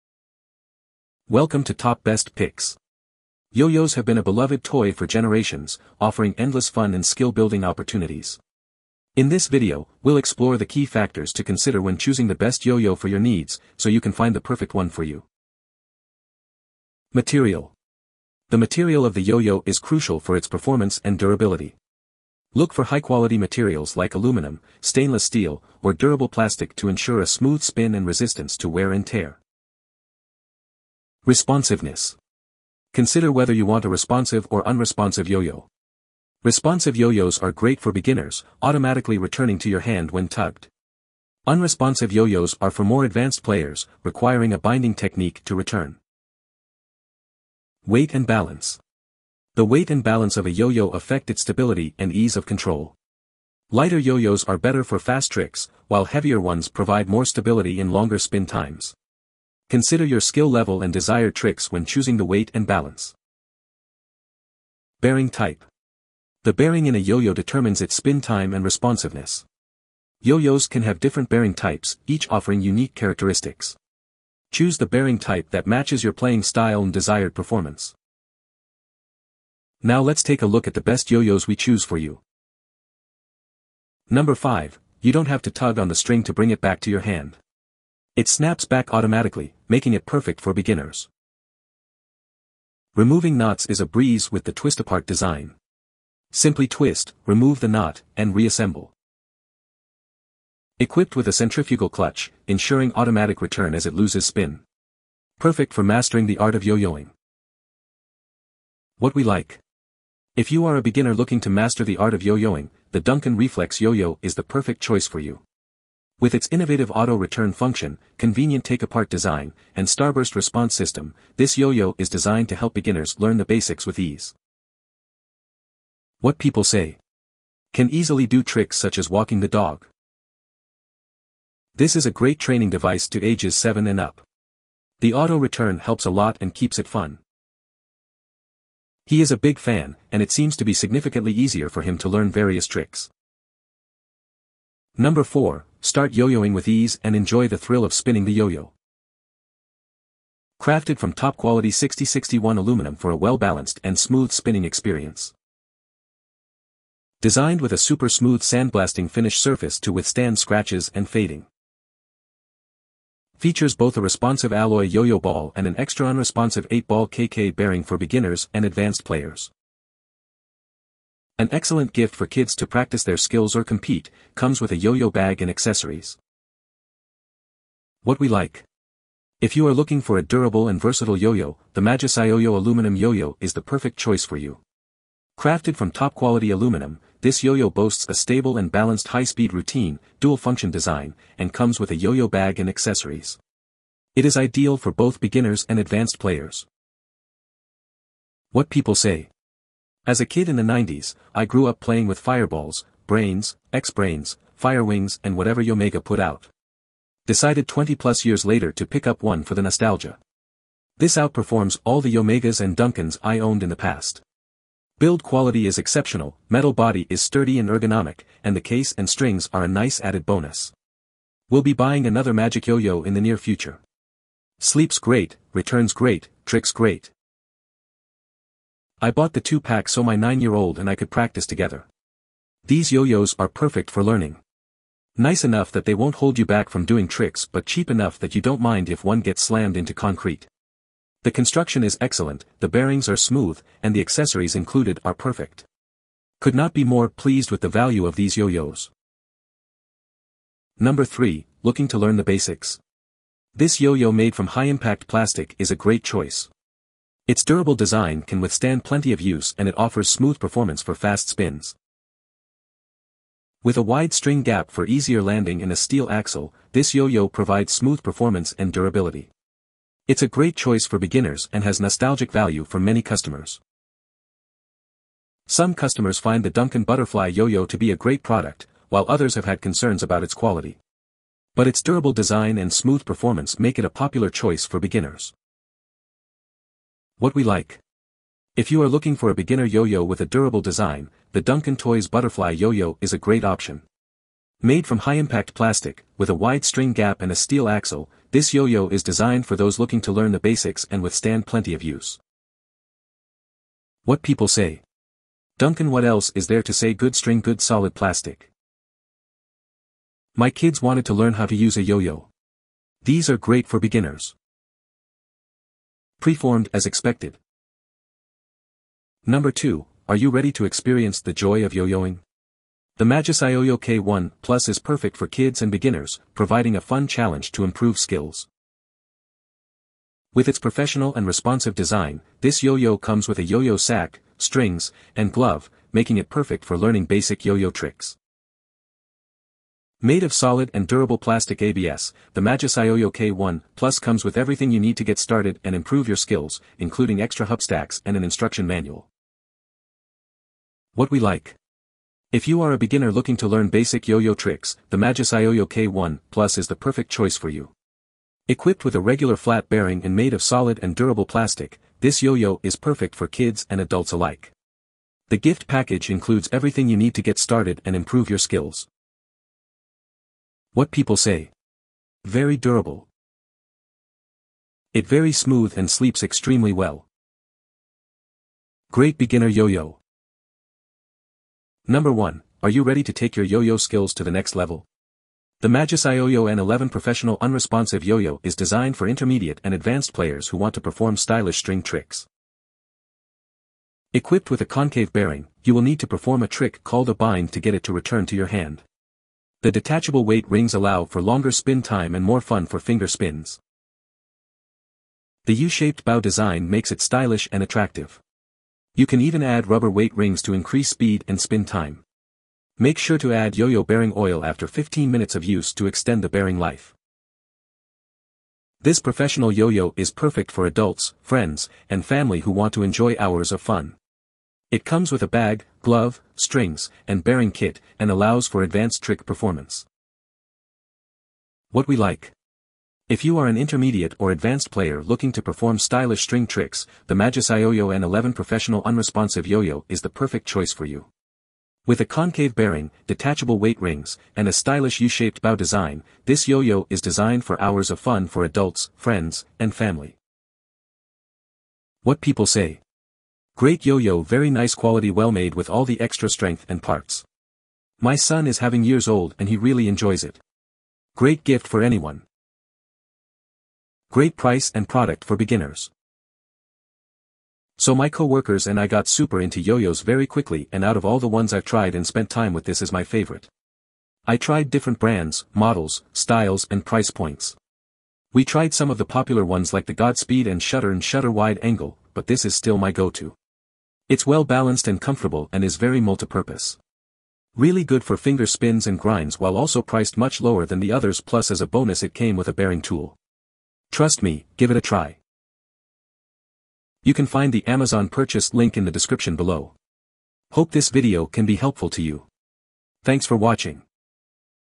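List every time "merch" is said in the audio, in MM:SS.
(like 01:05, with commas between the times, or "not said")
not said.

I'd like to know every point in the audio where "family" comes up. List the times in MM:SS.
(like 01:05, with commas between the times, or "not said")
07:02, 07:29.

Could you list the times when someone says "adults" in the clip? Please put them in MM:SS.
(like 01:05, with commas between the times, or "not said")
06:03, 07:00, 07:28.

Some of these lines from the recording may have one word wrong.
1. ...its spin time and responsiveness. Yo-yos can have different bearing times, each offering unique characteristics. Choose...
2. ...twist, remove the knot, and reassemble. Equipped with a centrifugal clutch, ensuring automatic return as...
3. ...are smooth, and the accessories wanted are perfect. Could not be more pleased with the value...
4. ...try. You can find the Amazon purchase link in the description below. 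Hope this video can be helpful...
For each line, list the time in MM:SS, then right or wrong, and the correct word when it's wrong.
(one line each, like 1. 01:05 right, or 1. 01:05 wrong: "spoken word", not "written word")
1. 01:07 wrong: "types", not "times"
2. 01:36 right
3. 04:03 wrong: "included", not "wanted"
4. 08:14 right.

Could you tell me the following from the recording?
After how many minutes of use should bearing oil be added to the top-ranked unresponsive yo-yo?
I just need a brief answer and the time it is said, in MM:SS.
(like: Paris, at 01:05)
15, at 06:54.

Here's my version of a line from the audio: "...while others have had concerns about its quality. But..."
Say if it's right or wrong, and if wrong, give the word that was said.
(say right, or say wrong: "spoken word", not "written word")
right.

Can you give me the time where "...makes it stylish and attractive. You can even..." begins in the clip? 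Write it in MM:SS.
06:46.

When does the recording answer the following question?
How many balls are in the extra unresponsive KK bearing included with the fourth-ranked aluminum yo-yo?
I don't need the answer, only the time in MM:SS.
02:46.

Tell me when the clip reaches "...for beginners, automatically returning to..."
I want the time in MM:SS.
00:37.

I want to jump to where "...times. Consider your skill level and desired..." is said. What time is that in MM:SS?
00:58.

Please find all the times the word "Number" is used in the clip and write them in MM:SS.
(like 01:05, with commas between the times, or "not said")
01:24, 02:24, 04:10, 05:19, 06:21.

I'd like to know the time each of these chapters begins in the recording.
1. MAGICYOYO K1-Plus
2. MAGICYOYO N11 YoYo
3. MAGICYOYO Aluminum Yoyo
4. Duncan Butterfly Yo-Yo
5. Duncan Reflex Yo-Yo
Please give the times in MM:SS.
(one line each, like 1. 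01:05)
1. 05:17
2. 06:20
3. 02:23
4. 04:09
5. 01:22.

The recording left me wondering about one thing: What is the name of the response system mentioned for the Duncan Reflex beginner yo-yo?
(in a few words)
starburst.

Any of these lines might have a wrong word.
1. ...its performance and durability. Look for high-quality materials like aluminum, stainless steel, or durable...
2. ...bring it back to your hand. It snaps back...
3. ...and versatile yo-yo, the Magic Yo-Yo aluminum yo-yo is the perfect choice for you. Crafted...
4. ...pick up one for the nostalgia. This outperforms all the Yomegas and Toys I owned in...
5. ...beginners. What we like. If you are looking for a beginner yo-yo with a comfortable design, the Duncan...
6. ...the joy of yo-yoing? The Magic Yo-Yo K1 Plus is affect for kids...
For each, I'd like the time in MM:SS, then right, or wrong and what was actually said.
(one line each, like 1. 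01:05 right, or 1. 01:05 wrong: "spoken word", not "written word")
1. 00:20 right
2. 01:26 right
3. 03:00 right
4. 03:28 wrong: "Duncans", not "Toys"
5. 04:44 wrong: "durable", not "comfortable"
6. 05:21 wrong: "perfect", not "affect".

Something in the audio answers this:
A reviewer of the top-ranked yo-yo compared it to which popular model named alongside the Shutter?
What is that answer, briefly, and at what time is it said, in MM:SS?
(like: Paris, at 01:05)
Godspeed, at 07:59.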